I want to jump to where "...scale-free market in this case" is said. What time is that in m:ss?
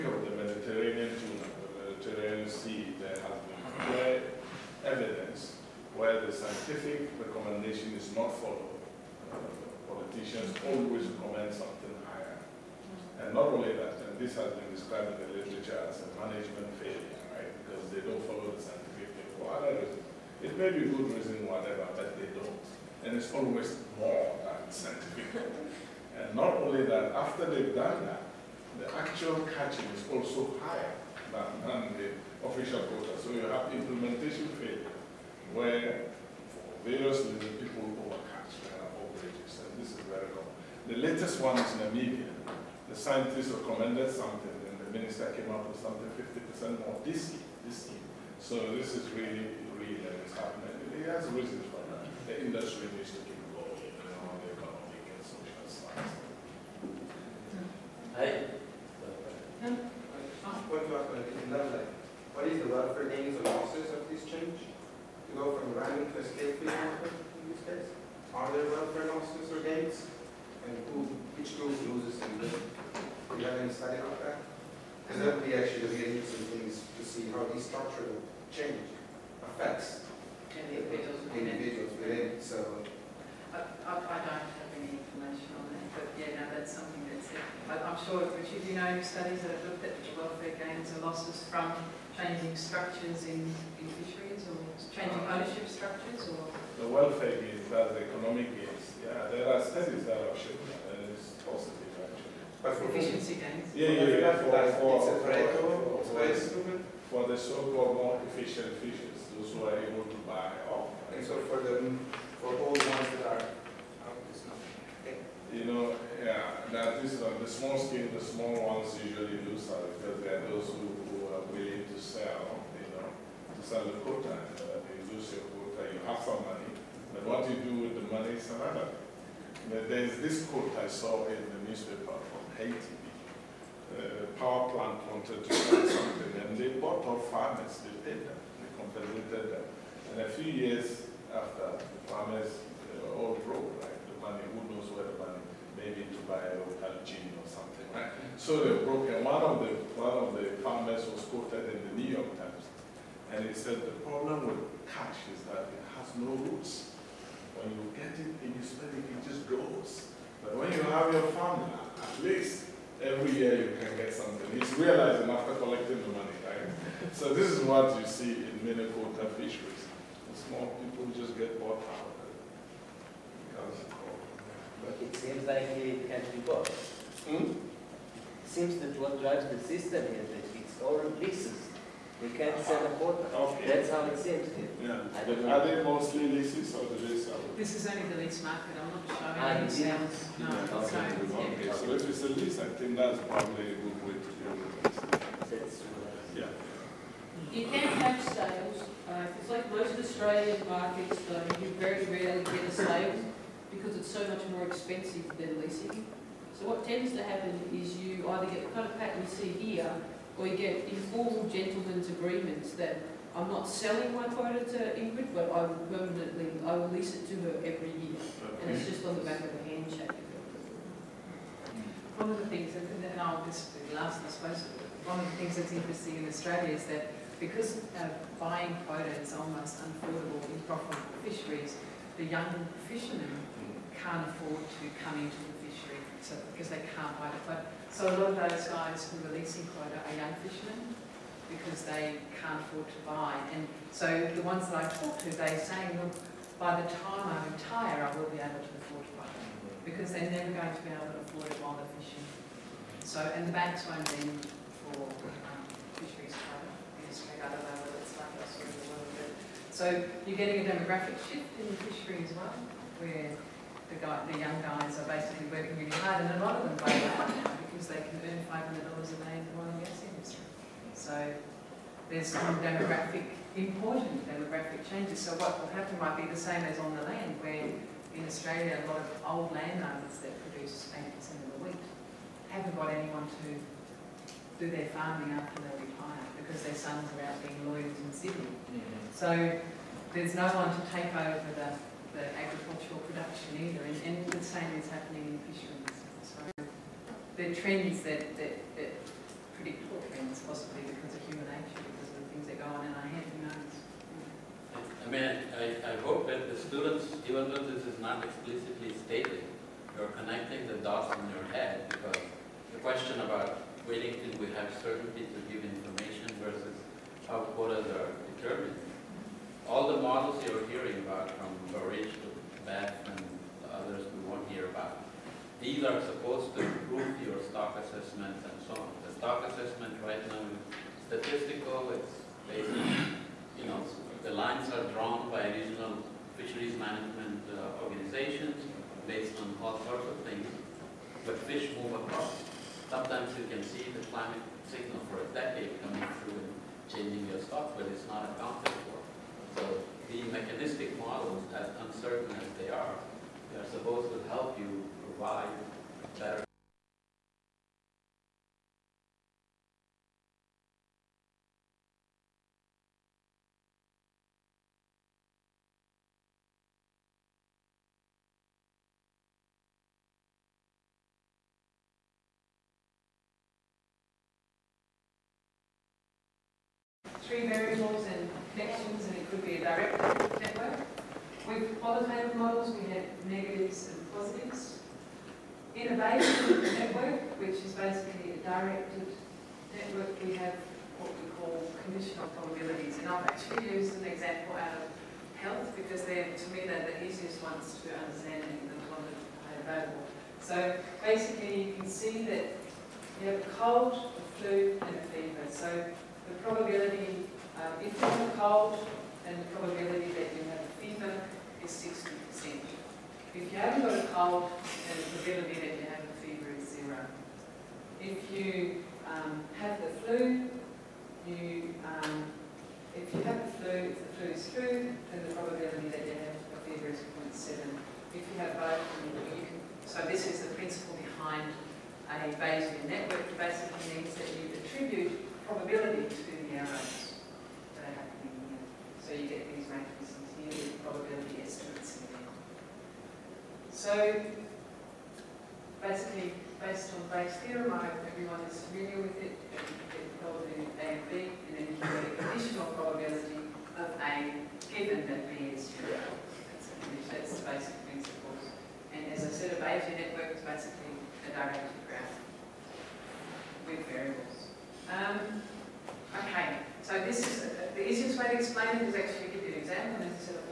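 1:06.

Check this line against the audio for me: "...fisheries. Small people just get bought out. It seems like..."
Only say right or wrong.
right.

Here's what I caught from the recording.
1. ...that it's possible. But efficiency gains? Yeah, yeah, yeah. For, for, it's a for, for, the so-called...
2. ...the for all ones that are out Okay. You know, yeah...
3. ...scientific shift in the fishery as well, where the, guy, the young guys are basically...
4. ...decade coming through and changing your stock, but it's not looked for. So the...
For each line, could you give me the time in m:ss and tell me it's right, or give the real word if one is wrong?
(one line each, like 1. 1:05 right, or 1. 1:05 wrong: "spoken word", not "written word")
1. 1:40 right
2. 1:51 right
3. 4:20 wrong: "demographic", not "scientific"
4. 5:45 wrong: "accounted", not "looked".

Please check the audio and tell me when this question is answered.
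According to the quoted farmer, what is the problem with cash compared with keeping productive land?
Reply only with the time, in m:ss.
2:35.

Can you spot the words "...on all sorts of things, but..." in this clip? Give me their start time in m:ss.
5:39.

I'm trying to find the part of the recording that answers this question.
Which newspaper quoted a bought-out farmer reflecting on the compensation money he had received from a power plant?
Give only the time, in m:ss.
2:32.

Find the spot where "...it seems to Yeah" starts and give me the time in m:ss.
3:04.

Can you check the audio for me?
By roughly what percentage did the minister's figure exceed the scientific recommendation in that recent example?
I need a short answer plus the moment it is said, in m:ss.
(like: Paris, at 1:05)
50%, at 0:46.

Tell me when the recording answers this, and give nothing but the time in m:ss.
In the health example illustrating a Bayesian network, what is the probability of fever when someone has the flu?
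7:06.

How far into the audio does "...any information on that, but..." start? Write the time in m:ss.
1:24.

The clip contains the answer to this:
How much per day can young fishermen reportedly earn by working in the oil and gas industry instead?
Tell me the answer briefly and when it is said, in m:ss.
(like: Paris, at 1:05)
$500, at 4:28.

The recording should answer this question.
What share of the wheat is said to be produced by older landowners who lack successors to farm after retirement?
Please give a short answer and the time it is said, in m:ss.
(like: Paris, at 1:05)
80%, at 4:40.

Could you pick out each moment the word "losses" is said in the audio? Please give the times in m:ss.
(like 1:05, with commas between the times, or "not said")
1:03, 1:09, 1:31.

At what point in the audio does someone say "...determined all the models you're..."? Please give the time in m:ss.
5:18.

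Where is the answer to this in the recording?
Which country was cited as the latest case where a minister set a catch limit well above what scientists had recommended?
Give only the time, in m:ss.
0:41.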